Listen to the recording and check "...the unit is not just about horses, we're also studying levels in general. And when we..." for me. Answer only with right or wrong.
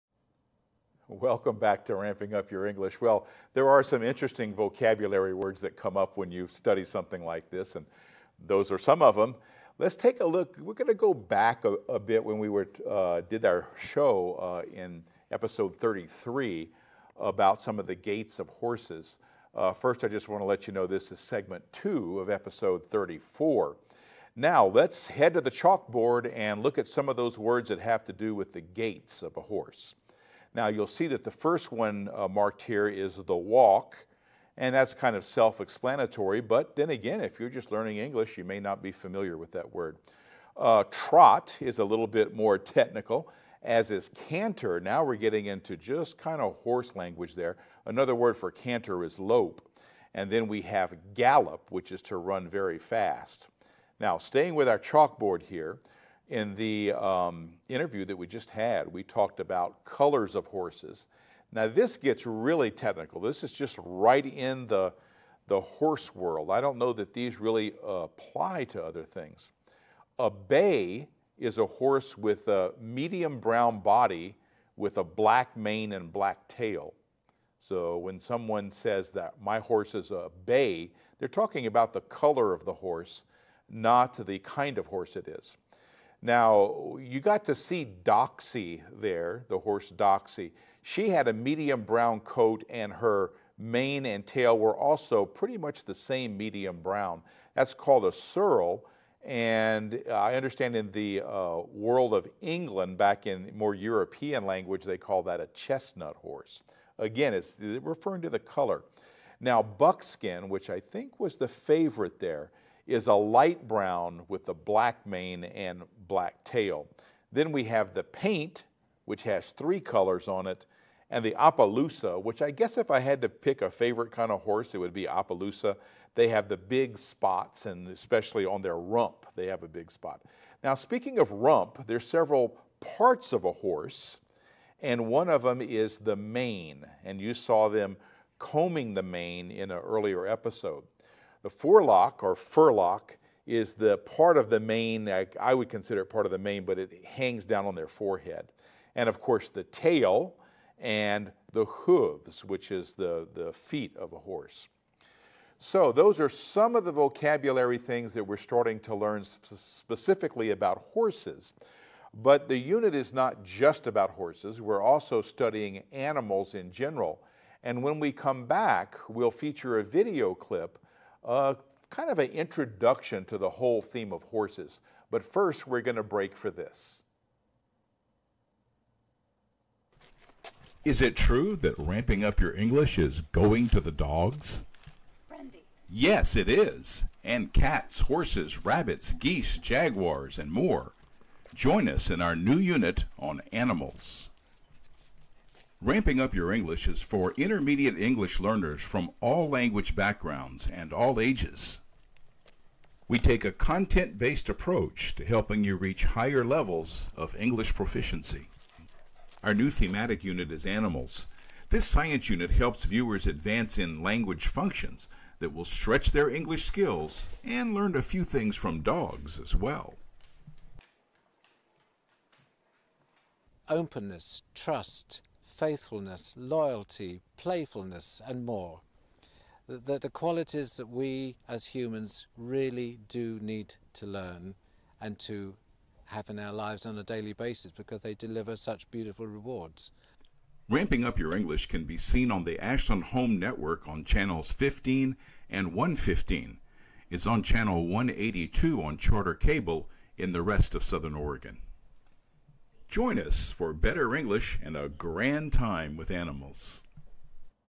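wrong.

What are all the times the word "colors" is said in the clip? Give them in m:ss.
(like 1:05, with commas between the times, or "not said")
0:59, 1:21, 1:48, 1:59.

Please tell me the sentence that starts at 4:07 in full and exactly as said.
It's on channel 182 on Charter Cable in the rest of Southern Oregon.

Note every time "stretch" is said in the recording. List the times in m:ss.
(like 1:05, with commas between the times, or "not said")
3:35.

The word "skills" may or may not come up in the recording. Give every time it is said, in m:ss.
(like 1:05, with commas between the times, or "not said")
3:36.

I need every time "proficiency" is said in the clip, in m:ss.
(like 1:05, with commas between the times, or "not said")
3:27.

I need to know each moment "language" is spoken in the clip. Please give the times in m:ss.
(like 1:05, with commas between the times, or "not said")
0:46, 1:44, 3:19, 3:34.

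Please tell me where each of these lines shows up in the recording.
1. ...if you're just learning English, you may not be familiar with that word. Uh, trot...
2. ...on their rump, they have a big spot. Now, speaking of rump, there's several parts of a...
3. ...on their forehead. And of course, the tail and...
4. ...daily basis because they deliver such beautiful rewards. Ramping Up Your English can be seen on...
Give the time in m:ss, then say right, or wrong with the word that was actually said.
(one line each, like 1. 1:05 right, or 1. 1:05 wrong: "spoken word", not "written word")
1. 0:37 right
2. 2:08 right
3. 2:27 right
4. 3:57 right.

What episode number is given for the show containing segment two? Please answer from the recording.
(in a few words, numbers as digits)
34.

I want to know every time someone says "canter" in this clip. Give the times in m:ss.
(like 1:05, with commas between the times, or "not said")
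0:44, 0:48.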